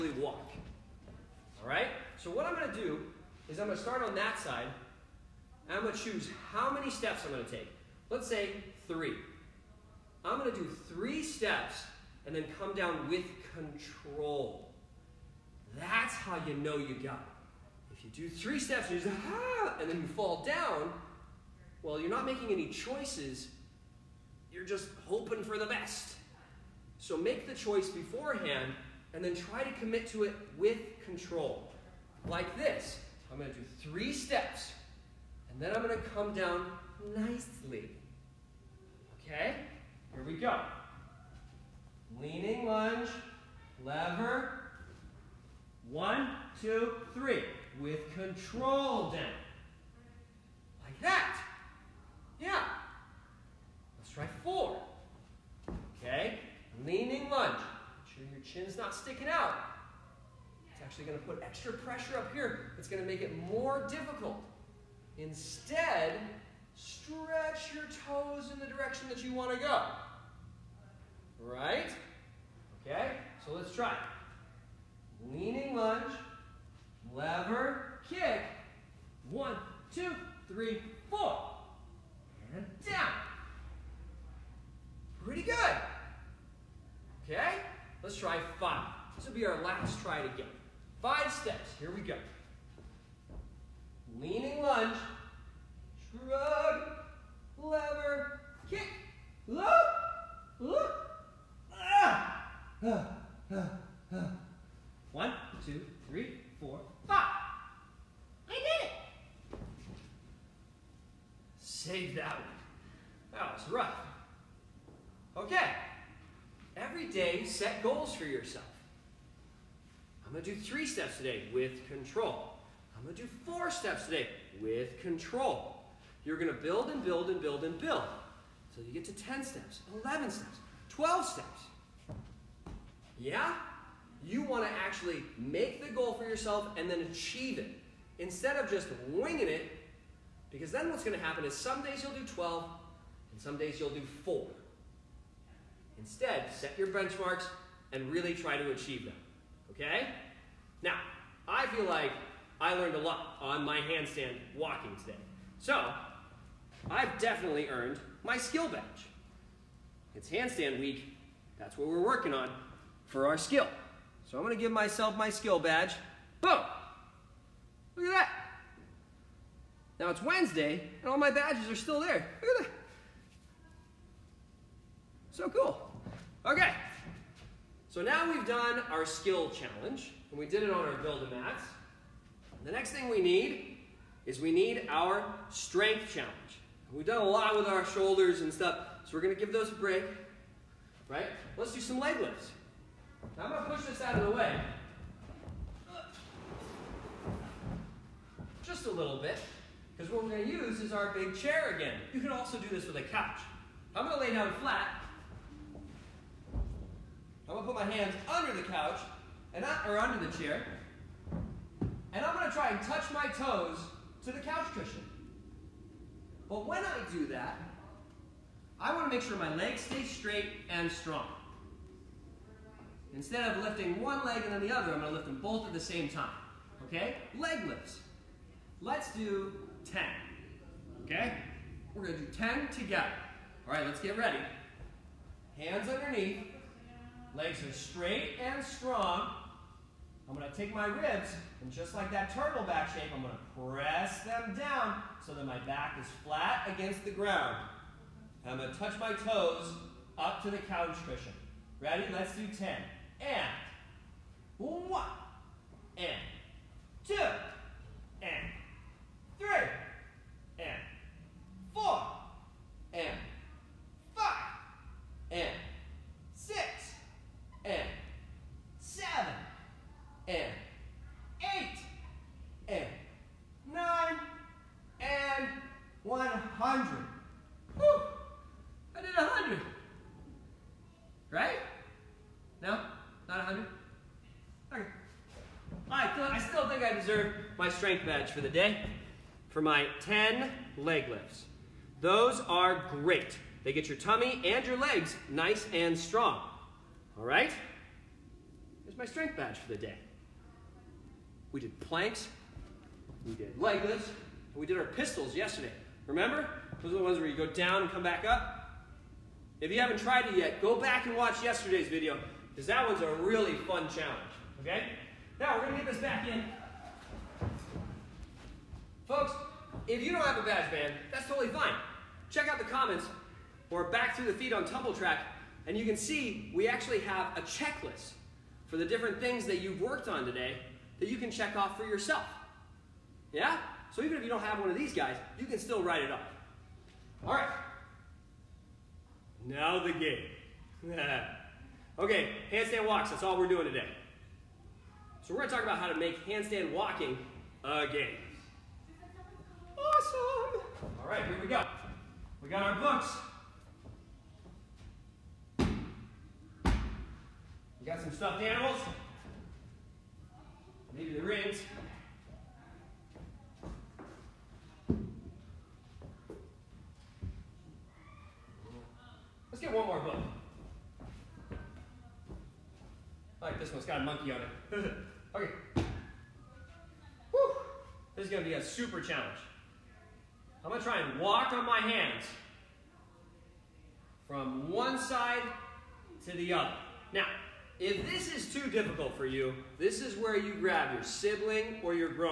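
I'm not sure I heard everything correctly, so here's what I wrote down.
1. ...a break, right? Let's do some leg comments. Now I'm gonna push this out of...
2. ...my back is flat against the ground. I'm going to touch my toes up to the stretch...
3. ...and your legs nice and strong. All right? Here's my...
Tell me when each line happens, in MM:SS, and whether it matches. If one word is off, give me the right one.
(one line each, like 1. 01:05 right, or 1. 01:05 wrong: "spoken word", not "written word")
1. 03:09 wrong: "lifts", not "comments"
2. 04:05 wrong: "couch", not "stretch"
3. 04:54 right.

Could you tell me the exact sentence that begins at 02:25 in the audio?
Instead, set your benchmarks and really try to achieve them.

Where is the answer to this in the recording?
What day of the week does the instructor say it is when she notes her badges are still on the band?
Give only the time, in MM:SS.
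02:50.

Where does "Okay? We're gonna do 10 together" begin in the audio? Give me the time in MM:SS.
03:51.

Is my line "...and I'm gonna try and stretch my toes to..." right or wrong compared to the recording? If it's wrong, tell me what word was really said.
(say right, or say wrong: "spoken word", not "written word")
wrong: "touch", not "stretch".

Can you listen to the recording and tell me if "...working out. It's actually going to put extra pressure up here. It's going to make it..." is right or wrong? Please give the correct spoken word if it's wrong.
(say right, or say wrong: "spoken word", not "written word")
wrong: "sticking", not "working".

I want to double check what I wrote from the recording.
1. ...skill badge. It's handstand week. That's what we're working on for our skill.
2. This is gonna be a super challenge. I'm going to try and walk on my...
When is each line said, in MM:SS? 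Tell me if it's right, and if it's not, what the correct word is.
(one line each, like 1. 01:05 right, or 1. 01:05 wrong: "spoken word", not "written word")
1. 02:38 right
2. 06:18 right.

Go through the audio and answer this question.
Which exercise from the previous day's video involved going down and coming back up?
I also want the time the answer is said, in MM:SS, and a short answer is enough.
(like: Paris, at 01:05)
pistols, at 05:04.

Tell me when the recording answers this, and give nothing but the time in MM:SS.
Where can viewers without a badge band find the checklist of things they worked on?
05:24.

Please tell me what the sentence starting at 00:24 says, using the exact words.
You're just hoping for the best.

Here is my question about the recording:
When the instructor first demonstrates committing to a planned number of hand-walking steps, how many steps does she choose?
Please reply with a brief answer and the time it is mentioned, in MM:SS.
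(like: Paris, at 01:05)
3, at 00:08.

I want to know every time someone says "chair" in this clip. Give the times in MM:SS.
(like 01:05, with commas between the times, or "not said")
03:21, 03:30.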